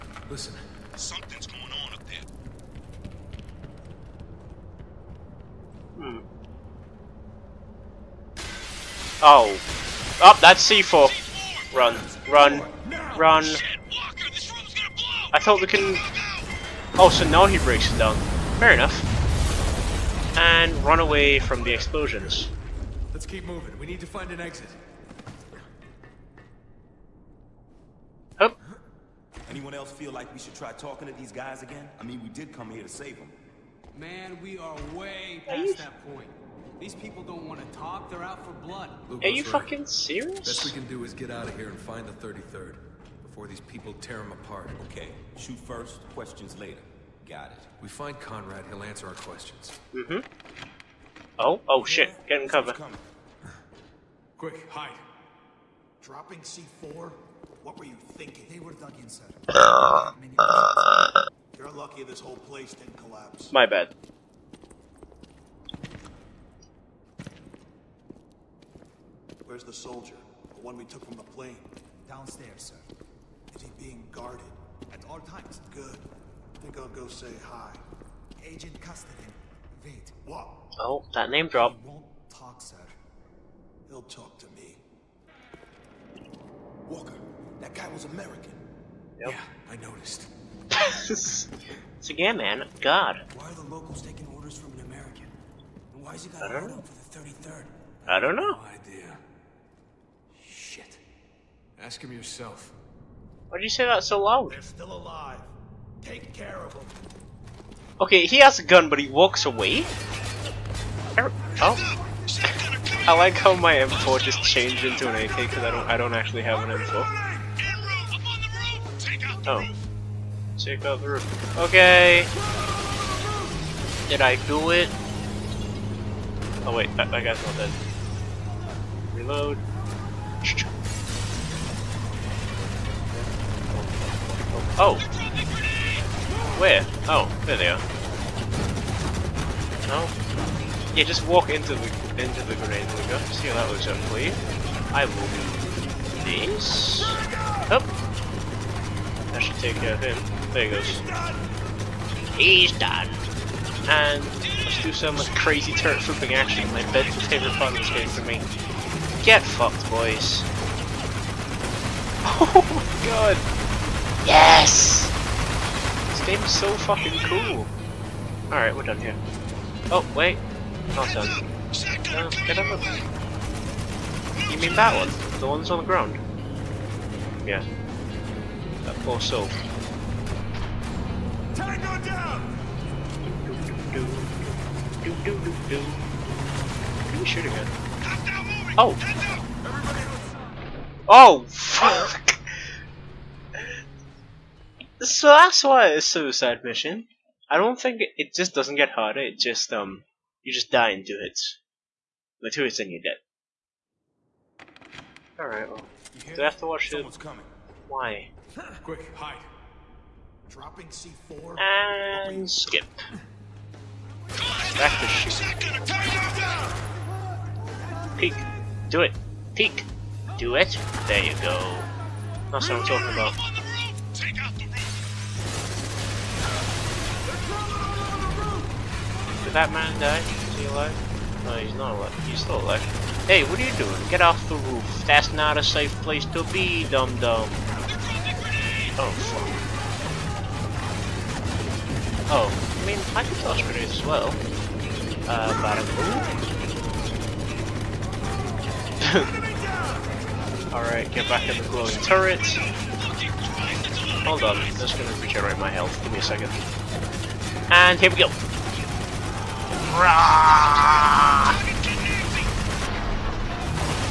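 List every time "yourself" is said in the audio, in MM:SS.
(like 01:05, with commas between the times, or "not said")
01:42.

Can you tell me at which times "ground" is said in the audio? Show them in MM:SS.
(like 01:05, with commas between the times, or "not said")
02:55.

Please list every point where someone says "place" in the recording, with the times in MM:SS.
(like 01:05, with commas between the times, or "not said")
01:02, 03:56.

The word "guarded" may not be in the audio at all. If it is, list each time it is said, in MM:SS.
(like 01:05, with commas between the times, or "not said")
01:14.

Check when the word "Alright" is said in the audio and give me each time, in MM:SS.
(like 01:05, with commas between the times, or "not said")
02:48, 04:10.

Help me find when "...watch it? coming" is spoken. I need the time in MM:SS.
03:26.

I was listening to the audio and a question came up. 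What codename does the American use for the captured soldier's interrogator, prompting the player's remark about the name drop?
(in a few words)
Agent Custodian.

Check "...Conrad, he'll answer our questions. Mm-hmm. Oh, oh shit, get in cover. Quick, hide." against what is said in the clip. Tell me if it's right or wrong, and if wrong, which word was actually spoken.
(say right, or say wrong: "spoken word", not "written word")
right.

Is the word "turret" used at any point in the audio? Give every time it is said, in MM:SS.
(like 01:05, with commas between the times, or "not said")
02:35, 04:12.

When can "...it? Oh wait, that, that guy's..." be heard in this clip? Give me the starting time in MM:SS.
02:04.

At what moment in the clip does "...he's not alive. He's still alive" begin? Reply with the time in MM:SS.
03:51.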